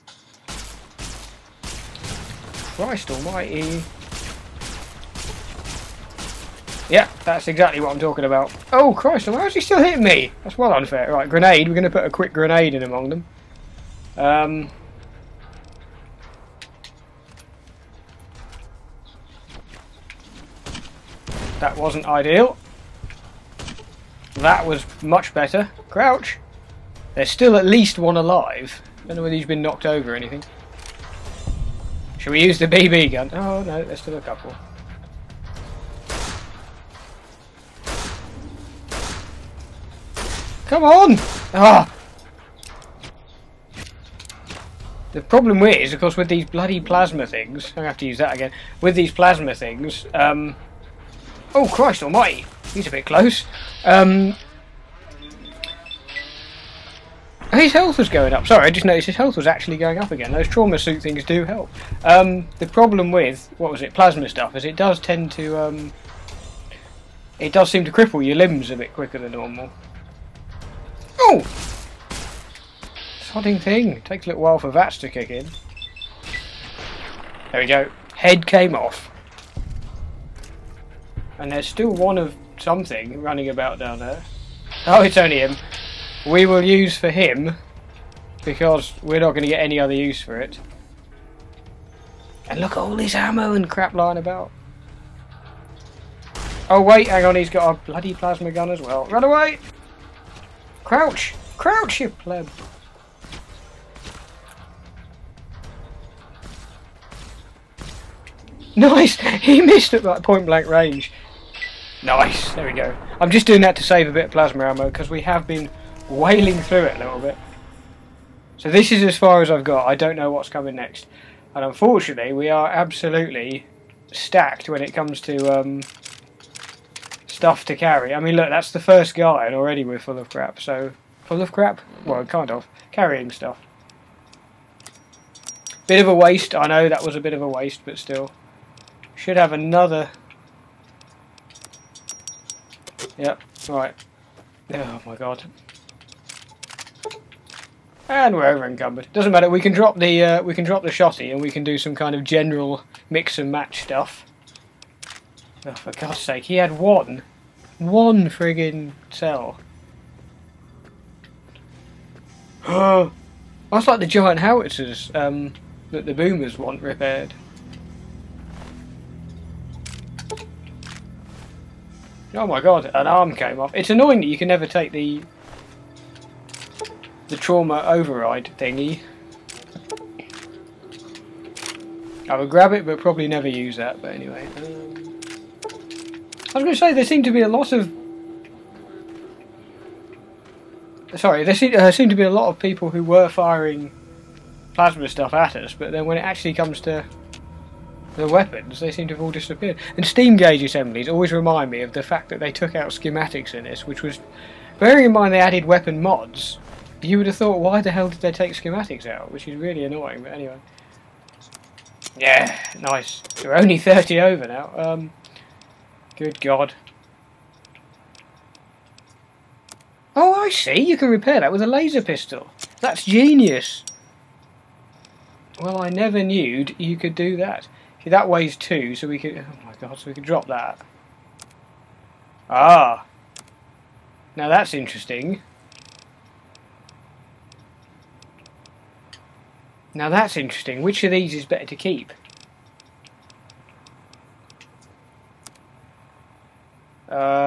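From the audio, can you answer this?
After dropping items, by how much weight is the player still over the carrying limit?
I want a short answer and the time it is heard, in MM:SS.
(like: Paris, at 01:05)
30, at 03:33.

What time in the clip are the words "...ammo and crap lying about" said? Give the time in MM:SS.
01:33.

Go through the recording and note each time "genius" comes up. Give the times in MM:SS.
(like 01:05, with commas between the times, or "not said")
03:43.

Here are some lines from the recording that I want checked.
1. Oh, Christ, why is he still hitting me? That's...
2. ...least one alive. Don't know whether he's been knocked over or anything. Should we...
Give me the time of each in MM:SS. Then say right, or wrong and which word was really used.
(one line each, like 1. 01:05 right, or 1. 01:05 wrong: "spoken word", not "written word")
1. 00:08 right
2. 00:27 right.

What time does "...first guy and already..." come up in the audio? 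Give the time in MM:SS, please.
02:08.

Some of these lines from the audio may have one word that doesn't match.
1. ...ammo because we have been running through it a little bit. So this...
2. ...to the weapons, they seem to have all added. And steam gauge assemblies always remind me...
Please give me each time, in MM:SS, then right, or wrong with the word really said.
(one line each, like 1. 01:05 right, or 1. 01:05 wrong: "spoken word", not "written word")
1. 01:54 wrong: "wailing", not "running"
2. 03:16 wrong: "disappeared", not "added".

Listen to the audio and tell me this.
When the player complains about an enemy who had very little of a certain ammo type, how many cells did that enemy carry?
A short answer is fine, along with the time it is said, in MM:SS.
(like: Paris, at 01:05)
1, at 02:37.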